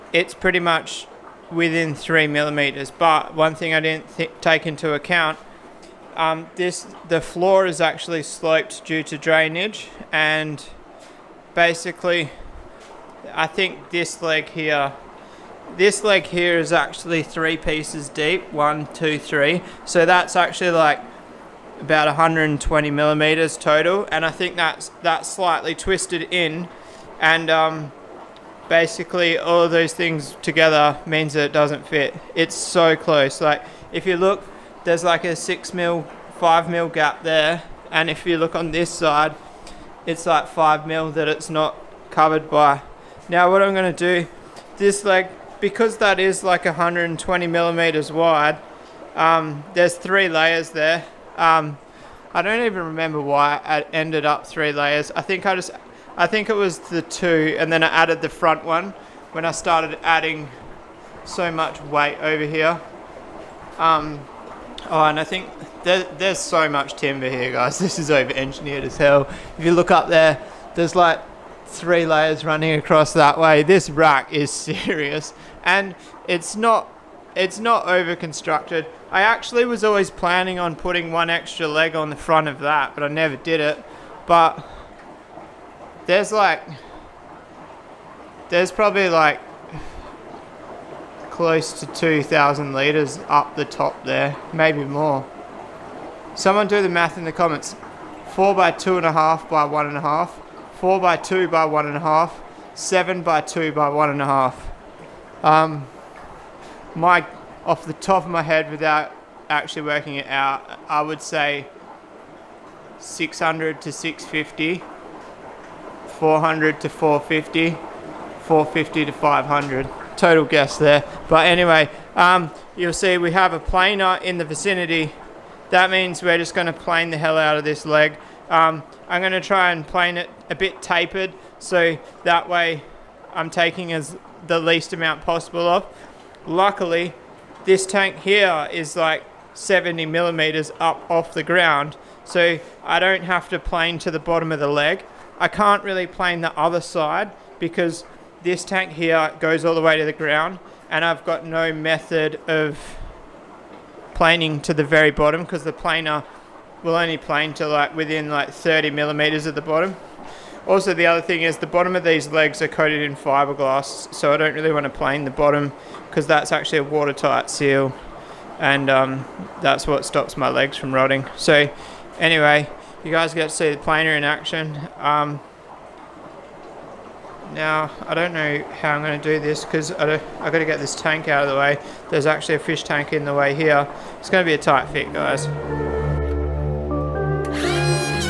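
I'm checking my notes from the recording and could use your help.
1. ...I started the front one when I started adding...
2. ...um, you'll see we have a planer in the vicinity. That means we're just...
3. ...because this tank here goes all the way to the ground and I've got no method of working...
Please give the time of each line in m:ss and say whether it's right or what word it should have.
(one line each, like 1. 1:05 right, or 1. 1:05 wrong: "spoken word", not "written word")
1. 0:57 wrong: "added", not "started"
2. 2:02 right
3. 2:27 wrong: "planing", not "working".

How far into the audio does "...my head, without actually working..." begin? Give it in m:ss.
1:48.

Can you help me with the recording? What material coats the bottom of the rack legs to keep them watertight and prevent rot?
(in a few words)
fiberglass.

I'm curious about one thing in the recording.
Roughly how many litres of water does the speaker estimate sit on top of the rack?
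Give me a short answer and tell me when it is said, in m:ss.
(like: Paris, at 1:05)
2,000 litres, at 1:31.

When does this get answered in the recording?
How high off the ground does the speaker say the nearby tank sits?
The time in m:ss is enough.
2:19.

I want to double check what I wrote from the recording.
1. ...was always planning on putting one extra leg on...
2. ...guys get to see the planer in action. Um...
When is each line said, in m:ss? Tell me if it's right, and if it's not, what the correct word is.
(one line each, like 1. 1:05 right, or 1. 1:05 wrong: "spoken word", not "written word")
1. 1:19 right
2. 2:53 right.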